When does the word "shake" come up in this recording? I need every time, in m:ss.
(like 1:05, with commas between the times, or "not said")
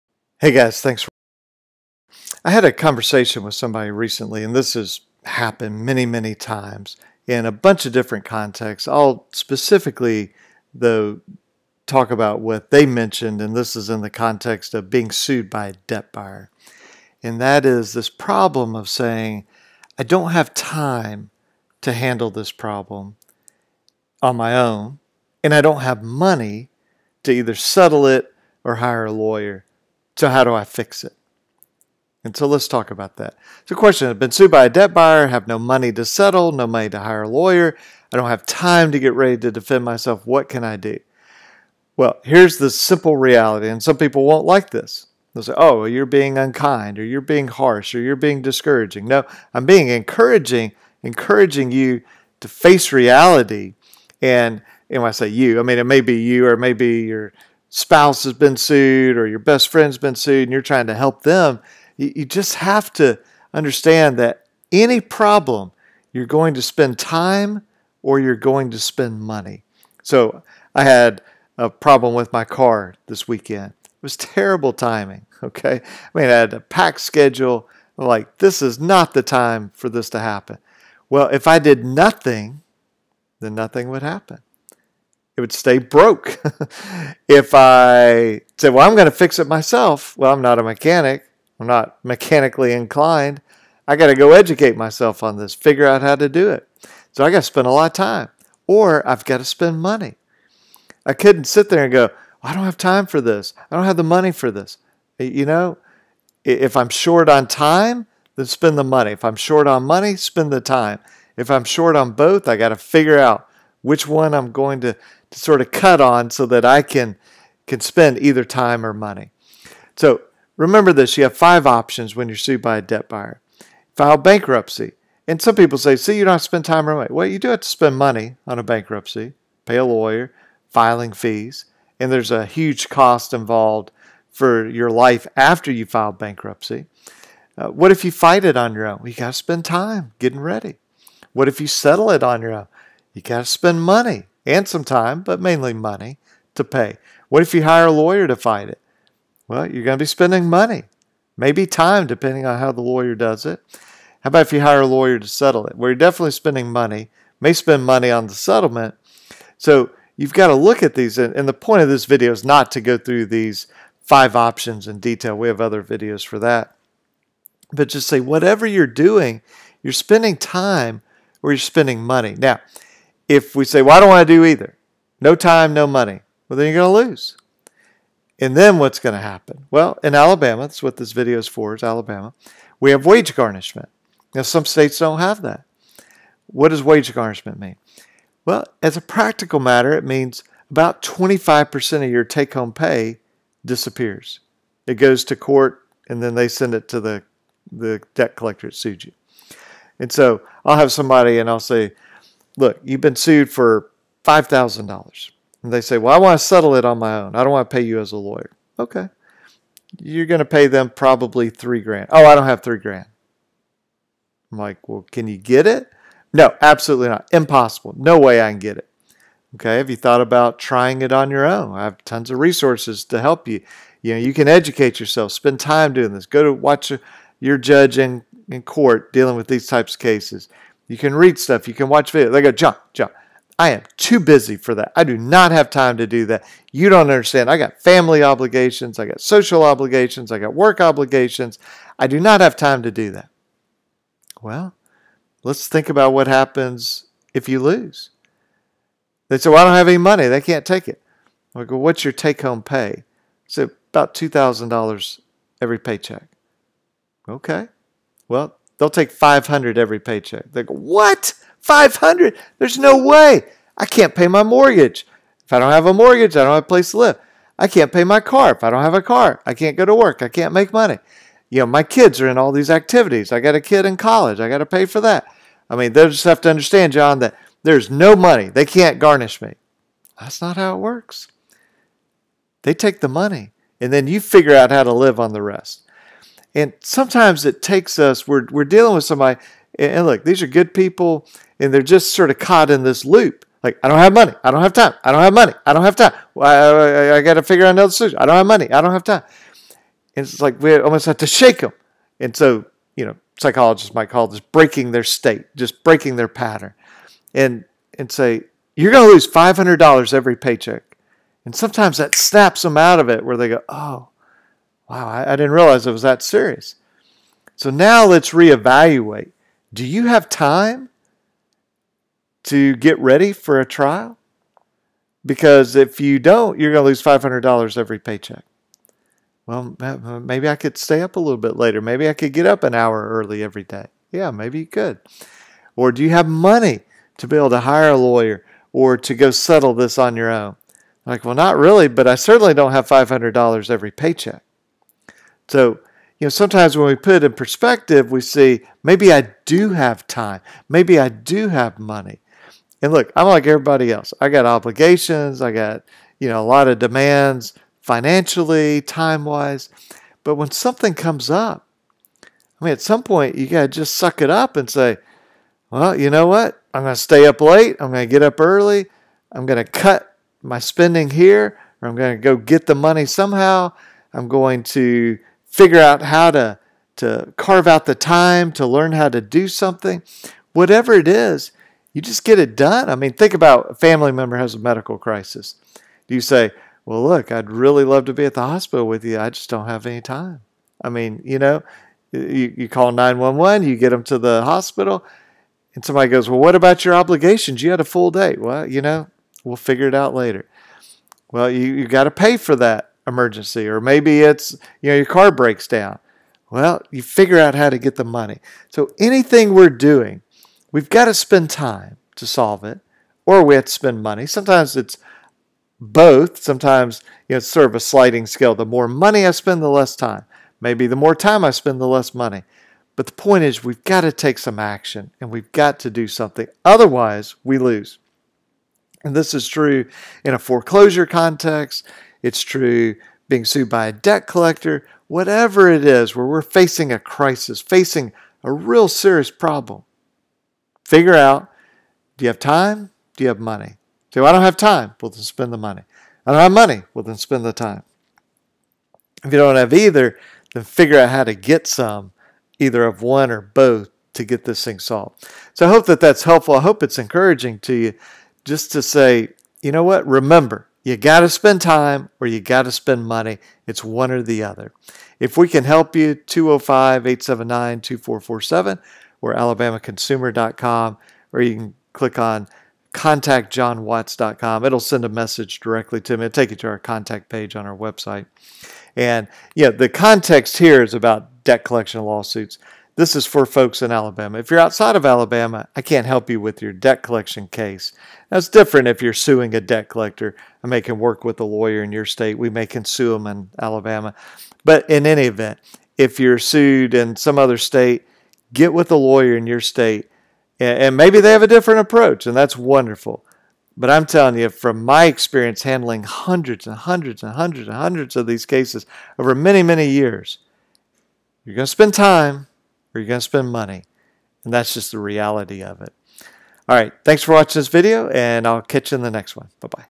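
5:01.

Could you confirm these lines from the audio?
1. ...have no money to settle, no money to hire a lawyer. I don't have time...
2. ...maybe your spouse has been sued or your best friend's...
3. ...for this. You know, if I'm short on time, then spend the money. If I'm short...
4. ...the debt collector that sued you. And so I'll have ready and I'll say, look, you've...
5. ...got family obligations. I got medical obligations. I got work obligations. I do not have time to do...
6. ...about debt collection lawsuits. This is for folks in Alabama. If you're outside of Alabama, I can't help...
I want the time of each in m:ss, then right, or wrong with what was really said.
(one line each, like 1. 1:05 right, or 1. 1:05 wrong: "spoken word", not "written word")
1. 0:35 right
2. 0:56 right
3. 1:44 right
4. 3:17 wrong: "somebody", not "ready"
5. 3:57 wrong: "social", not "medical"
6. 8:00 right.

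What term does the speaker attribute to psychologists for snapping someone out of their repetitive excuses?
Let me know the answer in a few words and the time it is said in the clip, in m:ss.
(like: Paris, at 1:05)
breaking their state, at 5:04.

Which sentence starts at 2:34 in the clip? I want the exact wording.
How about if you hire a lawyer to settle it?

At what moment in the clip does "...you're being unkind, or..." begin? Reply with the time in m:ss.
0:45.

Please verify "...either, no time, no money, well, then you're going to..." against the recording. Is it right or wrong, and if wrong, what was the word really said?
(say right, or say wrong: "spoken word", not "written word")
right.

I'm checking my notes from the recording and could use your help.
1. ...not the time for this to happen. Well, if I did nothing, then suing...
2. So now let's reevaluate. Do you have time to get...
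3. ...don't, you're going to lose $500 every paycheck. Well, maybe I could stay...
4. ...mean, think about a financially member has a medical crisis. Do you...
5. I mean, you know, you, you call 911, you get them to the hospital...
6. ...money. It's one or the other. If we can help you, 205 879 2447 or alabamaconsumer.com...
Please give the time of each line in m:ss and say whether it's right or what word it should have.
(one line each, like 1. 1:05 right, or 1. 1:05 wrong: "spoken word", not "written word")
1. 1:18 wrong: "nothing", not "suing"
2. 5:17 right
3. 5:26 right
4. 6:22 wrong: "family", not "financially"
5. 6:30 right
6. 7:43 right.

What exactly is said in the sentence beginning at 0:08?
I'll specifically, though, talk about what they mentioned, and this is in the context of being sued by a debt buyer.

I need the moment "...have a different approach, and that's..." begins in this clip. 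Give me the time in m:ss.
8:21.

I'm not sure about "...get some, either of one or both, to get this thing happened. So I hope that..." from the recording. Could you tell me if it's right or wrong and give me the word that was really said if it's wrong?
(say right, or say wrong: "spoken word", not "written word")
wrong: "solved", not "happened".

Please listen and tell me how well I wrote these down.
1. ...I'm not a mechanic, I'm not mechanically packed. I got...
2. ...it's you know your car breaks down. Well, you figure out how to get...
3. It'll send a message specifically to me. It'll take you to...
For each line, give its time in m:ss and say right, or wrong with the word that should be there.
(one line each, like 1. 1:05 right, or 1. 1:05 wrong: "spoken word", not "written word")
1. 1:30 wrong: "inclined", not "packed"
2. 6:44 right
3. 7:54 wrong: "directly", not "specifically".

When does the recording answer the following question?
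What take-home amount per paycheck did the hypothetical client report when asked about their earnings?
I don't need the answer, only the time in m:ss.
4:14.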